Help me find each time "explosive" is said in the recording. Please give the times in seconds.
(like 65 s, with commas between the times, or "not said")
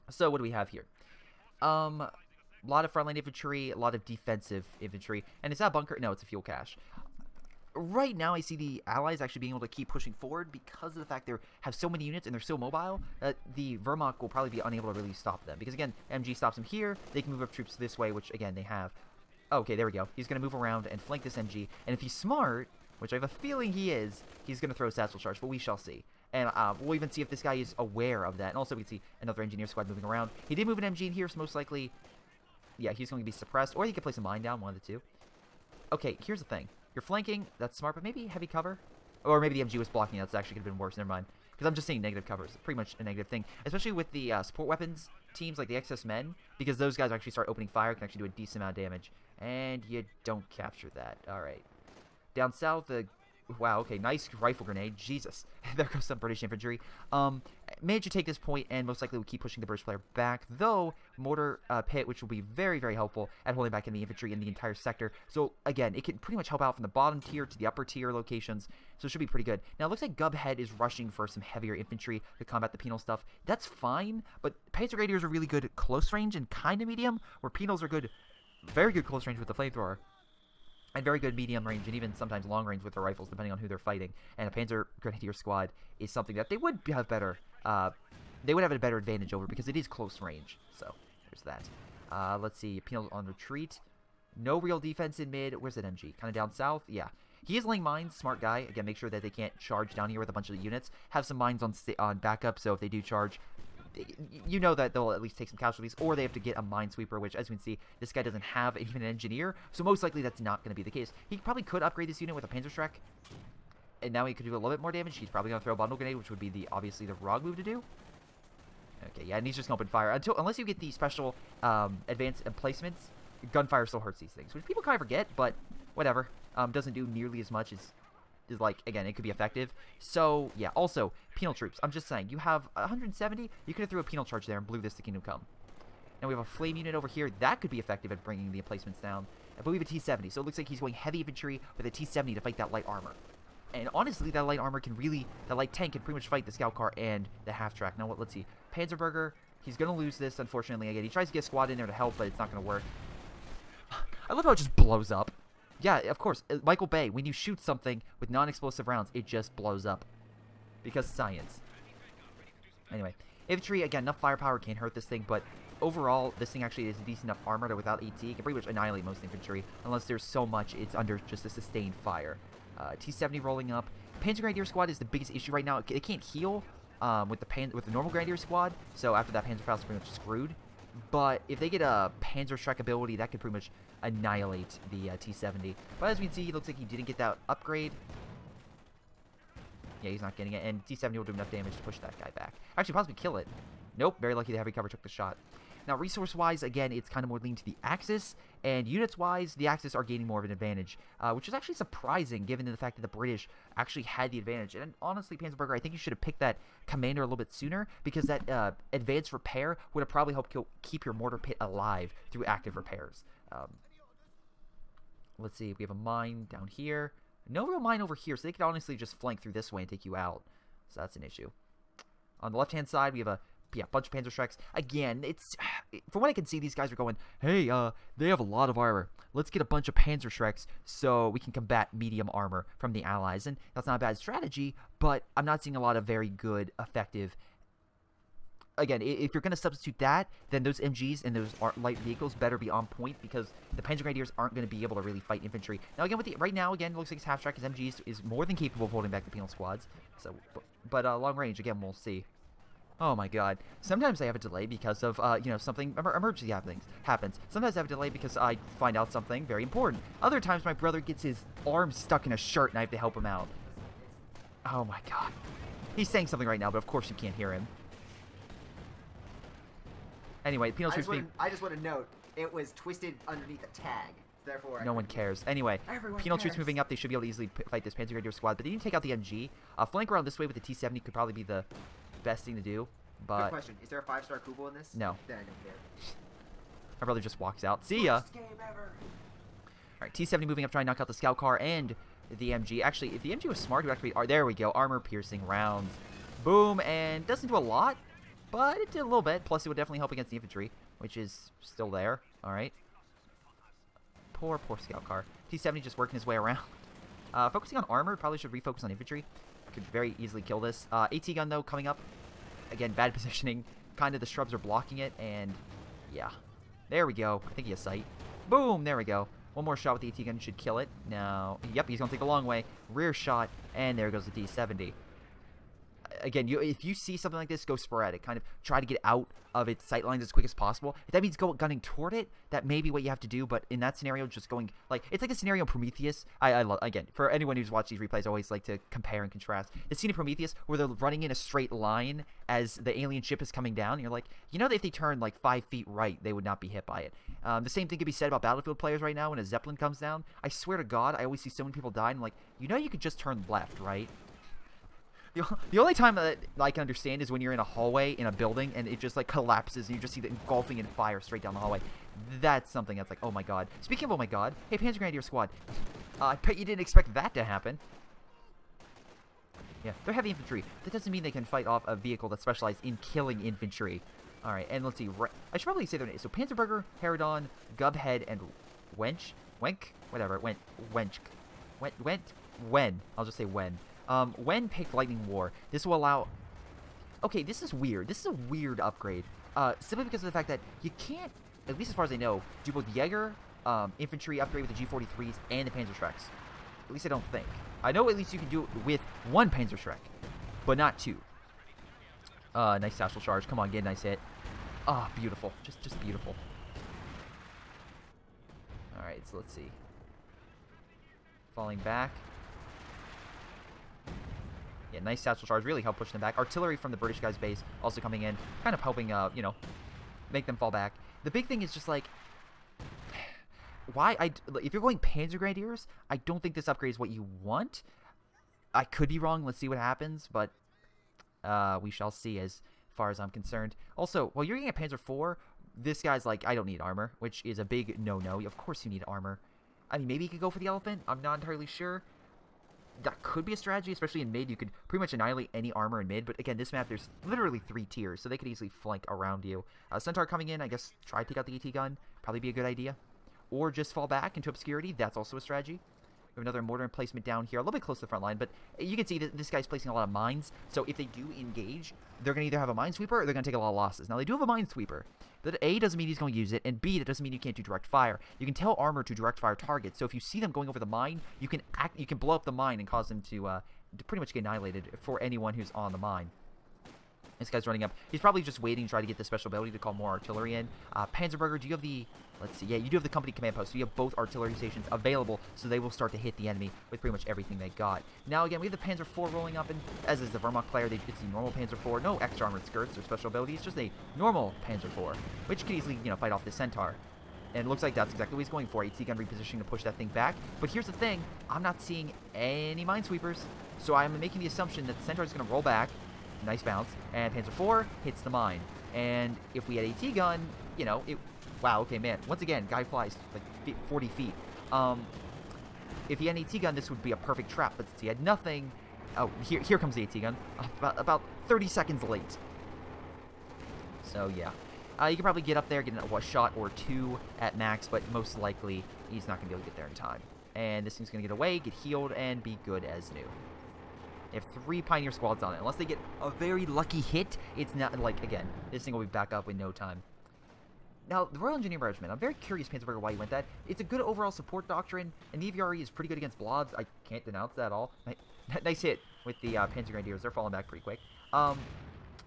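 158 s.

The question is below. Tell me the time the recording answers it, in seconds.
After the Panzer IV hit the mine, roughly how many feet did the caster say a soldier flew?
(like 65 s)
513 s.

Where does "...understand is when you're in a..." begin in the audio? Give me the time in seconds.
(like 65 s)
356 s.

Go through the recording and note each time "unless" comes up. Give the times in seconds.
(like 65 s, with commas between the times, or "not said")
120 s, 169 s, 535 s.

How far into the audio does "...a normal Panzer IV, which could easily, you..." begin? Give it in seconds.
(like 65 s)
493 s.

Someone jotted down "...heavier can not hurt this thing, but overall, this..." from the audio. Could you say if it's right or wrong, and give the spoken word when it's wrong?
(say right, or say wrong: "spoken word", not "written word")
wrong: "firepower", not "heavier".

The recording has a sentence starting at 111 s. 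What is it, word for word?
He probably could upgrade this unit with a Panzerschreck and now he could do a little bit more damage.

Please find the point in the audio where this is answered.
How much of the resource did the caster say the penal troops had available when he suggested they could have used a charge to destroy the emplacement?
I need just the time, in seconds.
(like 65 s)
132 s.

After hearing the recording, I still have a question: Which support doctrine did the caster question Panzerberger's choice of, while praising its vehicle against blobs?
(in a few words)
Royal Engineer Regiment.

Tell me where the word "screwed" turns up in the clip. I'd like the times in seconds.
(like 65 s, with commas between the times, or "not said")
180 s.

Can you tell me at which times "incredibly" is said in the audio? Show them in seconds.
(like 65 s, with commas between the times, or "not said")
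not said.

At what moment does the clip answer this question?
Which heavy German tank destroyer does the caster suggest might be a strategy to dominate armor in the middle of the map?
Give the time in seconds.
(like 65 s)
440 s.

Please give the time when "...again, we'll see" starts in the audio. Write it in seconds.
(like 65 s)
251 s.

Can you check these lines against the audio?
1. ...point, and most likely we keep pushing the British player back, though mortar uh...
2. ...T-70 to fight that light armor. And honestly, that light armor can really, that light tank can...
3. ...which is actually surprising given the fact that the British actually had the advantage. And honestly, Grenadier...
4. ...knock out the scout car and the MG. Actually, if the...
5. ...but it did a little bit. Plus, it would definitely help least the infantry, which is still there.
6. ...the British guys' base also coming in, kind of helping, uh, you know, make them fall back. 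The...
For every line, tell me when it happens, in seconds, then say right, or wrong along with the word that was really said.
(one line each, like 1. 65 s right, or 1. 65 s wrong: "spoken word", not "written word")
1. 58 s right
2. 141 s right
3. 201 s wrong: "Panzerberger", not "Grenadier"
4. 290 s right
5. 298 s wrong: "against", not "least"
6. 416 s right.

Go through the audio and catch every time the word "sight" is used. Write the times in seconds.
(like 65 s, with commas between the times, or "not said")
317 s, 329 s.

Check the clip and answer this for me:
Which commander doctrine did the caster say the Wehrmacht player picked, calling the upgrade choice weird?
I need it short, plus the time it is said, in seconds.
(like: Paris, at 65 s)
Lightning War, at 384 s.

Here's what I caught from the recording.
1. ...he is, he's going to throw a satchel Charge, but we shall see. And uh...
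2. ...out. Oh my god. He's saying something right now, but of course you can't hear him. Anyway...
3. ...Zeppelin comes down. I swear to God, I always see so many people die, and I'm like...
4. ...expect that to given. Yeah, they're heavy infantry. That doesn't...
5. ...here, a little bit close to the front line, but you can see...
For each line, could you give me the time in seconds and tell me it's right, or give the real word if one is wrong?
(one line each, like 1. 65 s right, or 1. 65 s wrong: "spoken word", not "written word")
1. 23 s right
2. 263 s right
3. 349 s right
4. 366 s wrong: "happen", not "given"
5. 457 s right.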